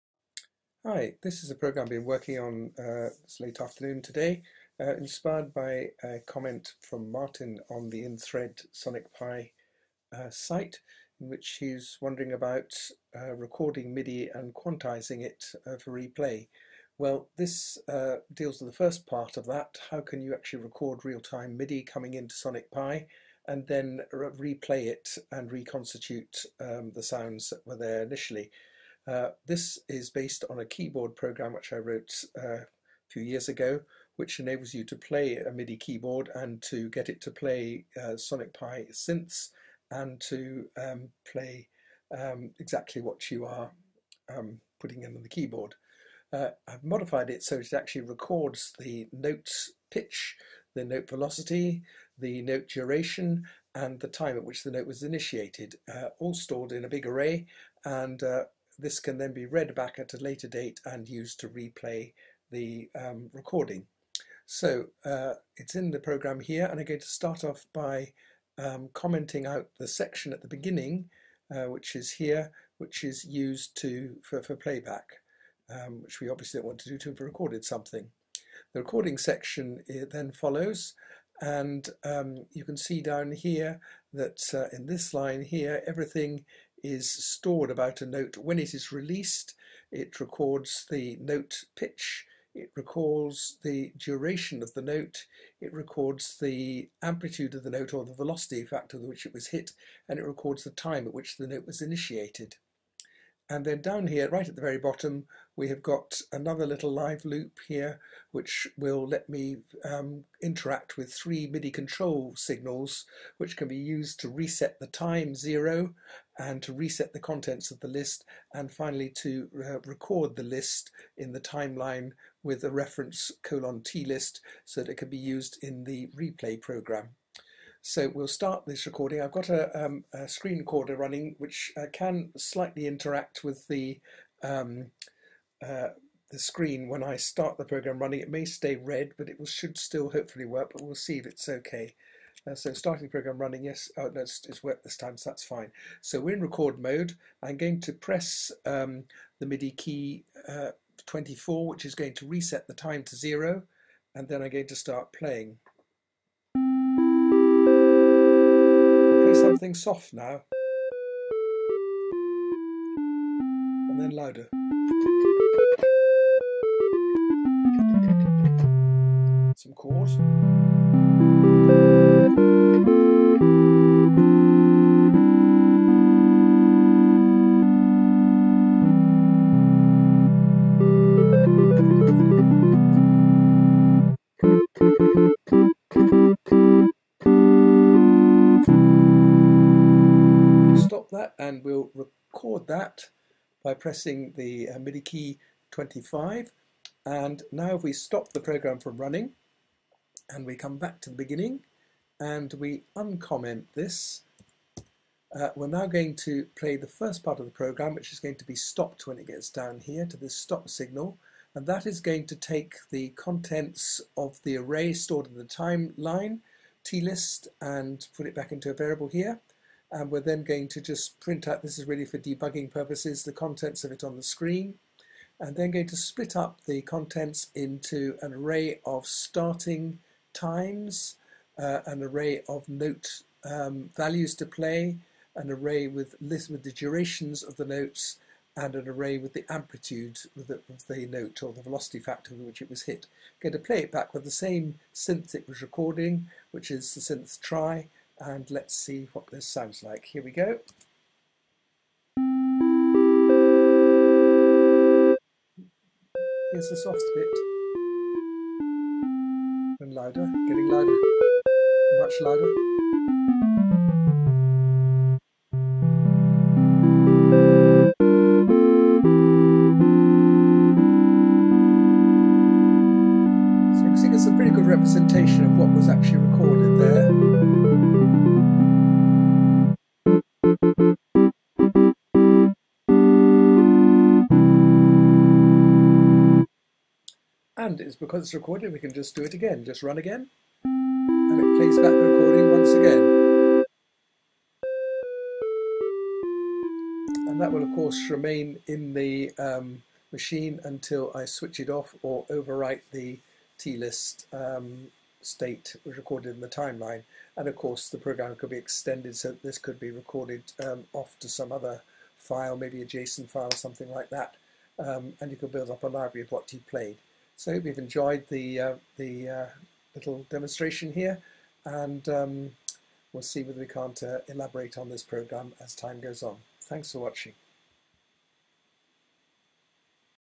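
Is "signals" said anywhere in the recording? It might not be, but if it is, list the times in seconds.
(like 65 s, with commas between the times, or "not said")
112 s, 210 s.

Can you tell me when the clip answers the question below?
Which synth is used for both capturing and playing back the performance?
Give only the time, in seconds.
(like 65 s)
247 s.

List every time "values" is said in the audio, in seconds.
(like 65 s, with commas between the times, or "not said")
233 s.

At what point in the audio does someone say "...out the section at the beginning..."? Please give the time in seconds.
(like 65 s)
69 s.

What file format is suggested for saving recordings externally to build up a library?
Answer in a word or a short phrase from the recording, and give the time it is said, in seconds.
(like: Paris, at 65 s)
JSON, at 312 s.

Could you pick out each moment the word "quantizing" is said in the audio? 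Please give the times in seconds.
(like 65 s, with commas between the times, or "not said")
14 s.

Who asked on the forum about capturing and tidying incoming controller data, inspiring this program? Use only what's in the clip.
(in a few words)
Martin.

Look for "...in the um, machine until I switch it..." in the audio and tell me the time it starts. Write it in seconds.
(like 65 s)
298 s.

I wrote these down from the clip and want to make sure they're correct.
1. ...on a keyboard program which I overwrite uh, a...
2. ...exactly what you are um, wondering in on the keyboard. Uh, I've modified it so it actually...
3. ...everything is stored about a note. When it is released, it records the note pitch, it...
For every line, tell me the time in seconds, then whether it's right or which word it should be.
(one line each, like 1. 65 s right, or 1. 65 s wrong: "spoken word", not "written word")
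1. 30 s wrong: "wrote", not "overwrite"
2. 42 s wrong: "putting", not "wondering"
3. 85 s right.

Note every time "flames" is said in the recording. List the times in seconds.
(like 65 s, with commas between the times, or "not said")
not said.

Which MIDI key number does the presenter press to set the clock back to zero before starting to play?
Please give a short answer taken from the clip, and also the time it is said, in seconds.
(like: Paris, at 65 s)
24, at 151 s.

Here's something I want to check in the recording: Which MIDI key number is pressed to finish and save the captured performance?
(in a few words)
25.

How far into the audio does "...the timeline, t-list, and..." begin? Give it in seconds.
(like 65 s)
215 s.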